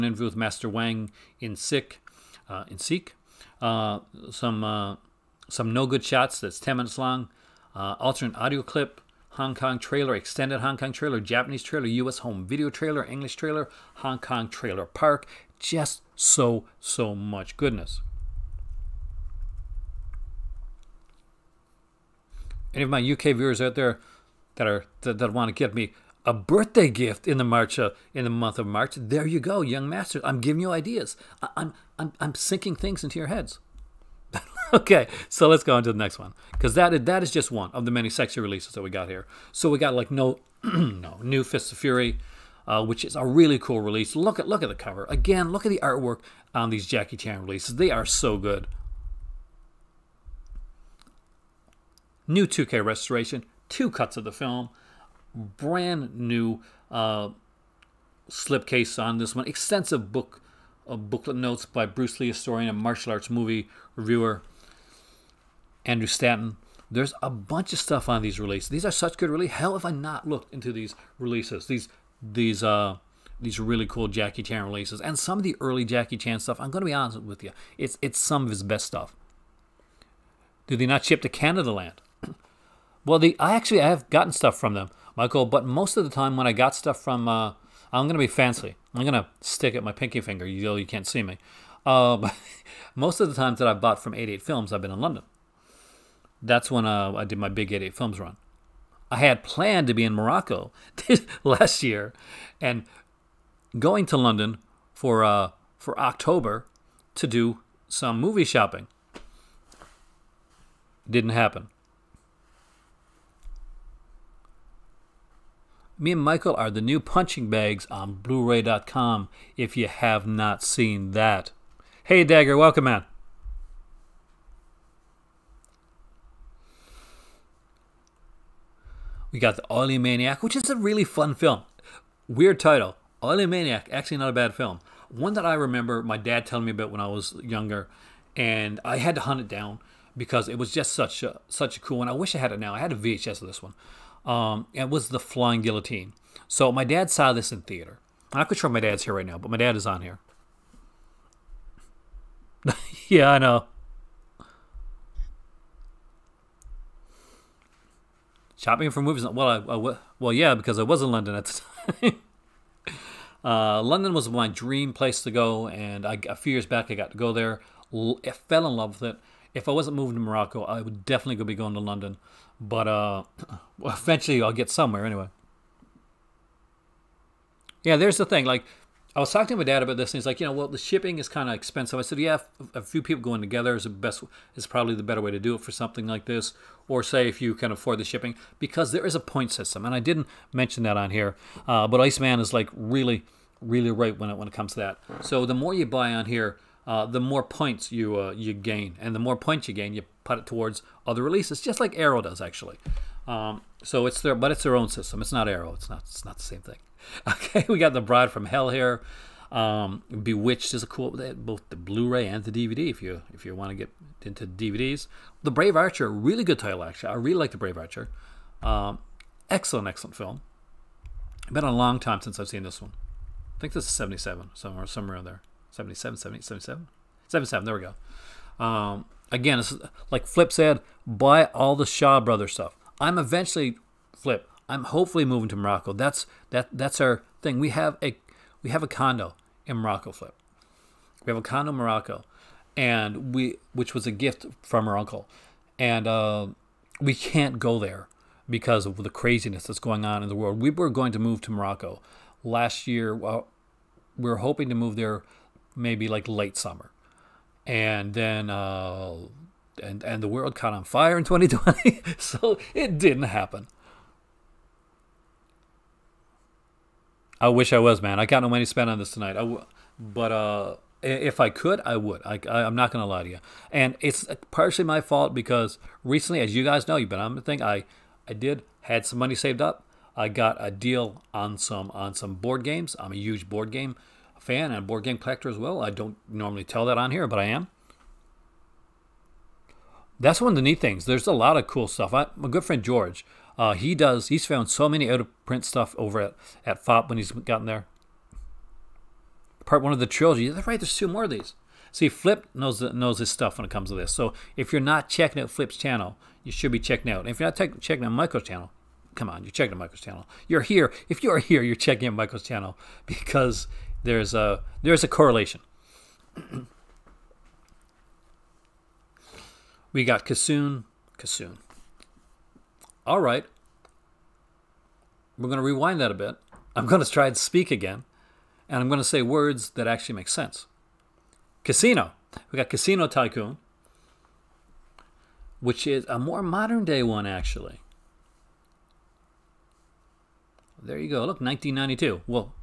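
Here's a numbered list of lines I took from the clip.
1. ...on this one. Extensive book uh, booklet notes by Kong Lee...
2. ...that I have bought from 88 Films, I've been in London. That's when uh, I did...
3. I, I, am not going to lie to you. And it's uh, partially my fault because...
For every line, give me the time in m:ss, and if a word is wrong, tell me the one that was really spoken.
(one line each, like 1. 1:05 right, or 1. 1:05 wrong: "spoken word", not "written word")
1. 0:59 wrong: "Bruce", not "Kong"
2. 1:33 right
3. 4:32 right.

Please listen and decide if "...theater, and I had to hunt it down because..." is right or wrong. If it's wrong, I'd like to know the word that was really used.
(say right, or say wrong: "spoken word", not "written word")
wrong: "younger", not "theater".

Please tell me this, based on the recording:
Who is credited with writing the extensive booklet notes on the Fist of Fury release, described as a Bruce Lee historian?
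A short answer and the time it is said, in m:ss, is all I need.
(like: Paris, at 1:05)
Andrew Stanton, at 1:05.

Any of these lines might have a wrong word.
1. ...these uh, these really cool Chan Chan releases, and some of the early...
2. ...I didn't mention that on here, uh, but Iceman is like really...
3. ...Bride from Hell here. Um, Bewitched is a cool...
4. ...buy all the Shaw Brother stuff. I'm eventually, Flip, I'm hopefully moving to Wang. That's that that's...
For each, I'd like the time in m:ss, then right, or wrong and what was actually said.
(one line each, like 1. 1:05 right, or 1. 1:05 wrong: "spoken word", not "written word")
1. 1:12 wrong: "Jackie", not "Chan"
2. 3:09 right
3. 3:28 right
4. 3:51 wrong: "Morocco", not "Wang".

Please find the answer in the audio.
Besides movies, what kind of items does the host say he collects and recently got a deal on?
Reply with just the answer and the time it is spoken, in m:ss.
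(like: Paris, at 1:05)
board games, at 4:42.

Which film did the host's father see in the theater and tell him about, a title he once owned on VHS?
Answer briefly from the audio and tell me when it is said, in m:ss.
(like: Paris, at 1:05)
The Flying Guillotine, at 2:25.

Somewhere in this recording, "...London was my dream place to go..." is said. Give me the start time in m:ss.
2:43.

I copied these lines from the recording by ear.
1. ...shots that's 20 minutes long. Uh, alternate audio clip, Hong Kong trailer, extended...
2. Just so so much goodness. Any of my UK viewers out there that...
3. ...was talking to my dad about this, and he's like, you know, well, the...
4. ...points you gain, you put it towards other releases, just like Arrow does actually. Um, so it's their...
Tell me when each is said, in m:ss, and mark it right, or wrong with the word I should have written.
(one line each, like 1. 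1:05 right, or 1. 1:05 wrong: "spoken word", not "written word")
1. 0:06 wrong: "10", not "20"
2. 0:15 right
3. 2:59 right
4. 3:19 right.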